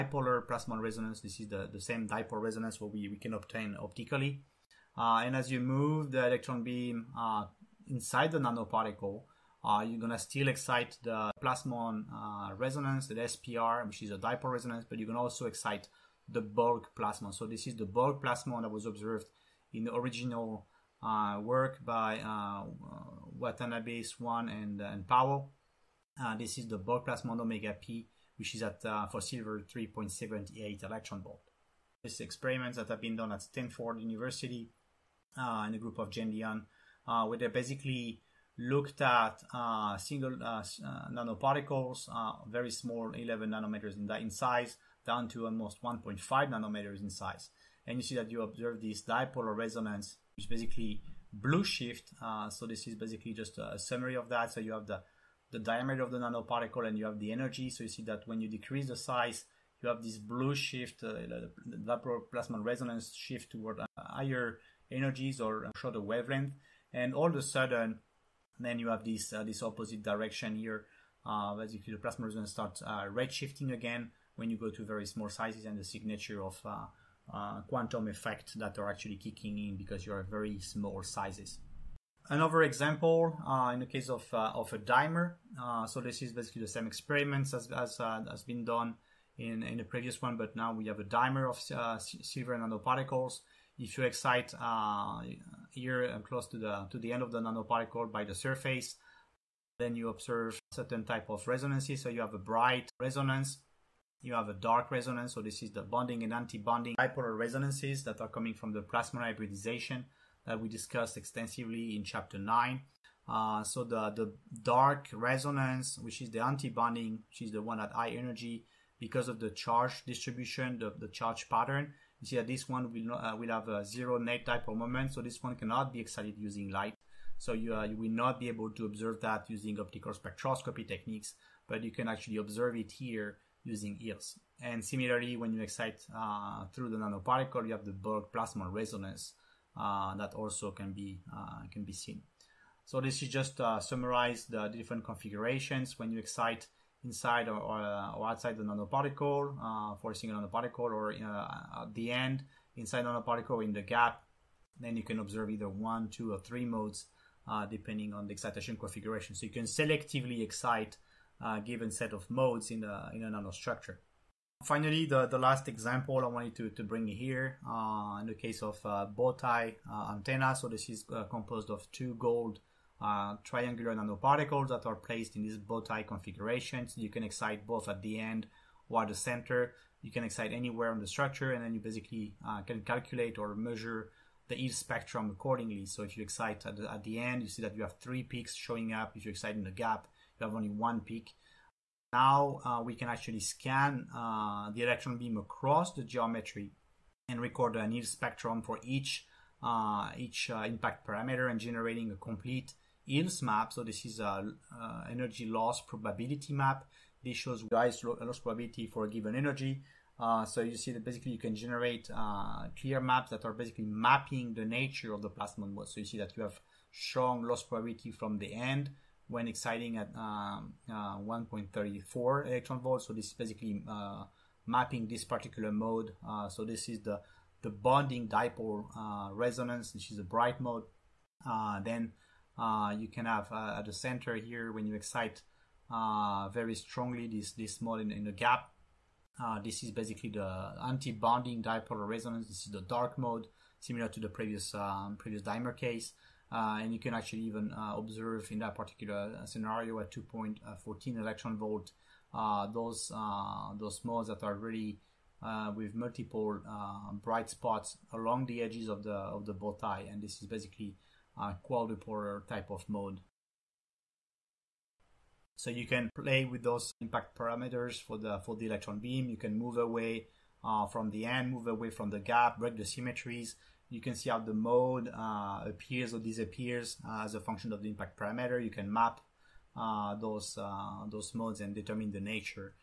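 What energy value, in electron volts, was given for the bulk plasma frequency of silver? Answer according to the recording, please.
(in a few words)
3.78 eV.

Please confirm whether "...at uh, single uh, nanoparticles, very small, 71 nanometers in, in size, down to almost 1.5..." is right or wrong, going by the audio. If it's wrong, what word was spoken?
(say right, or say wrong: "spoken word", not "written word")
wrong: "11", not "71".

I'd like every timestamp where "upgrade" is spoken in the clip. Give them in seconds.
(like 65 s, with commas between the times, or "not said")
not said.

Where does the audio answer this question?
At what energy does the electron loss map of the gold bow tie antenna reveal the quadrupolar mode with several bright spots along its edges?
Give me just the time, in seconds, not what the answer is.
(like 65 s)
250 s.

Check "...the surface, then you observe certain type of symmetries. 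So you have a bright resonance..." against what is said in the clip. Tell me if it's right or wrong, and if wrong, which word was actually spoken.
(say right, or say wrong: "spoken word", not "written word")
wrong: "resonances", not "symmetries".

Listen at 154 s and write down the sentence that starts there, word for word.
Then you can observe either one, two, or three modes uh, depending on the excitation configuration.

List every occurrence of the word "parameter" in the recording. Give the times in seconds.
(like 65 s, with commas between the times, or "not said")
201 s, 267 s, 278 s.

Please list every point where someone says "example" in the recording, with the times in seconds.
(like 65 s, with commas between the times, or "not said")
82 s, 165 s.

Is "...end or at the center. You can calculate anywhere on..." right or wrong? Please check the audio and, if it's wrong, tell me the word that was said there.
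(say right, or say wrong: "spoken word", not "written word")
wrong: "excite", not "calculate".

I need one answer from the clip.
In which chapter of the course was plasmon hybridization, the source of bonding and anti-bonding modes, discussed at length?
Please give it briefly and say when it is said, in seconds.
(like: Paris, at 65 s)
Chapter 9, at 112 s.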